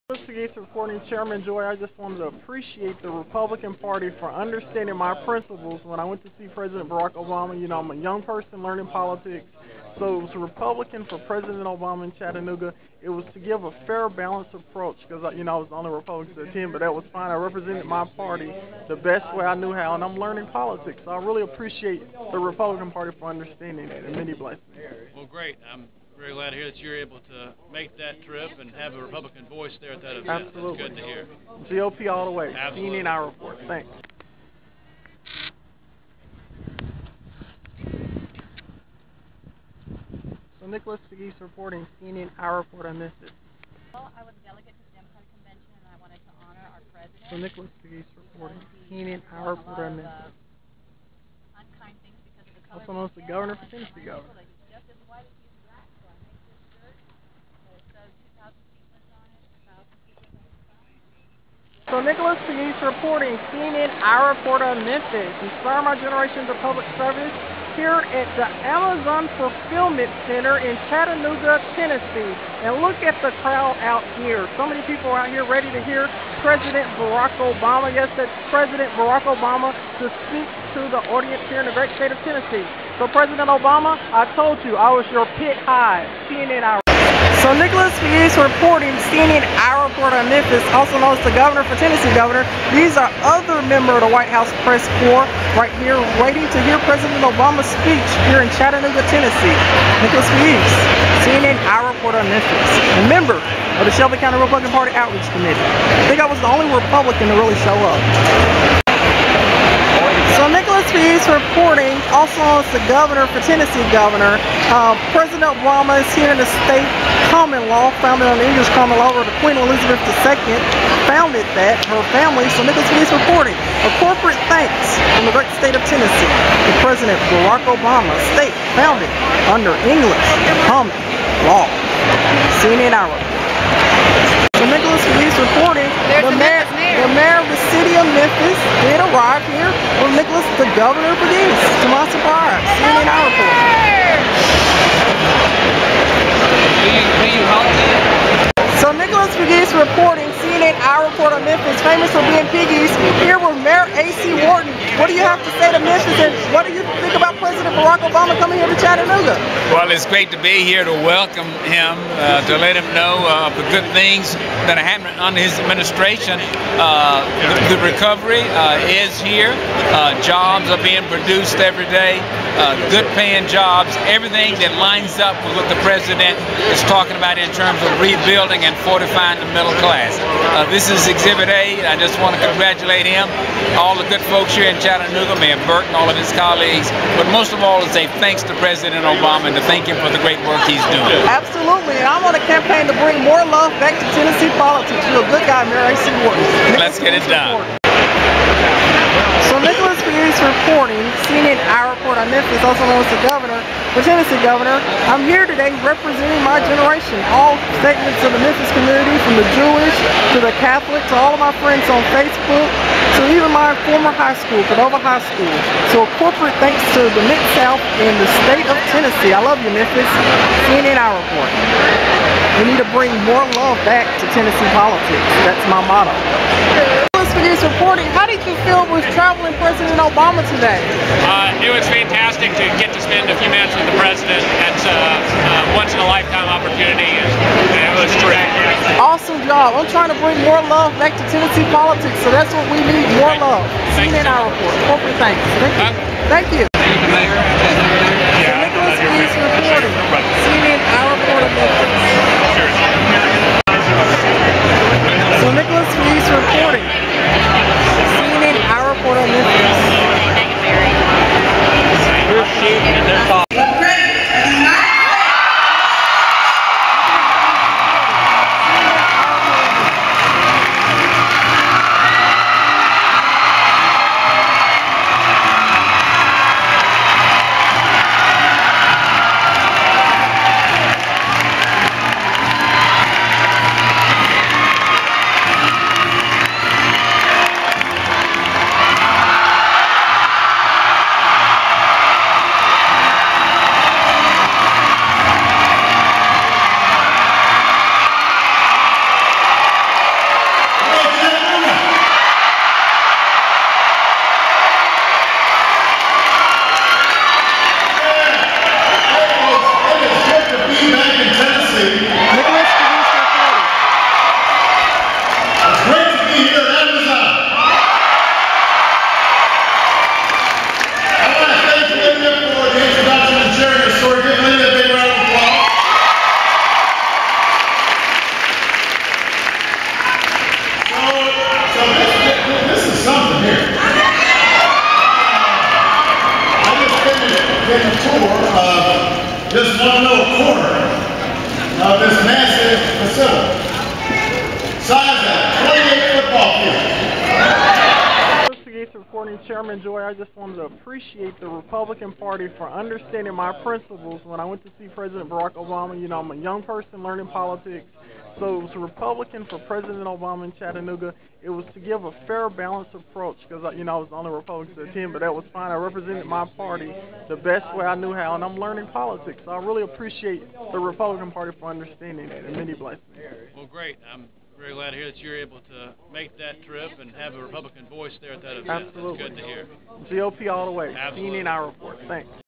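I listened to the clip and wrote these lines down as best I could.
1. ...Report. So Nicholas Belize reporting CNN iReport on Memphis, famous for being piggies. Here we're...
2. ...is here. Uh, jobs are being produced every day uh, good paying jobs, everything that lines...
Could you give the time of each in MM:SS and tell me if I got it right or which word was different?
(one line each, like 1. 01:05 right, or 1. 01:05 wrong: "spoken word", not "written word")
1. 02:27 right
2. 02:48 right.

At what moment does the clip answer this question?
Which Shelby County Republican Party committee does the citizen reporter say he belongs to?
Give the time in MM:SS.
01:44.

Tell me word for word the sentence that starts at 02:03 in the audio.
A corporate thanks from the great state of Tennessee to President Barack Obama, state founded under English common law.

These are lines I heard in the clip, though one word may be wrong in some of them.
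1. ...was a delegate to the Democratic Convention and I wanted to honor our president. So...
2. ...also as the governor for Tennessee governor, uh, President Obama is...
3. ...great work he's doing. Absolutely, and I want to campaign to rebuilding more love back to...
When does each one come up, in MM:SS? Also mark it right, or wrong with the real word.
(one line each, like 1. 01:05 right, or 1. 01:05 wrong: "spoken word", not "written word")
1. 00:44 right
2. 01:52 right
3. 03:10 wrong: "bring", not "rebuilding".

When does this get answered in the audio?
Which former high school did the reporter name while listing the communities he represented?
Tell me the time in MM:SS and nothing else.
03:34.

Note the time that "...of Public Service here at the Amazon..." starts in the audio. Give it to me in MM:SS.
01:06.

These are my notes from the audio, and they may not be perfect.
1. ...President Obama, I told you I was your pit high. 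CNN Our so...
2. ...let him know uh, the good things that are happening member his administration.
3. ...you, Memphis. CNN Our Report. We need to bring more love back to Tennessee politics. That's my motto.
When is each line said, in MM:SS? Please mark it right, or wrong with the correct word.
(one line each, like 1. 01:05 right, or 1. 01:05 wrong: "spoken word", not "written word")
1. 01:23 right
2. 02:42 wrong: "under", not "member"
3. 03:39 right.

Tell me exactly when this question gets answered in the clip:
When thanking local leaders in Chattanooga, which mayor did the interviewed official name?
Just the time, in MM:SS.
03:05.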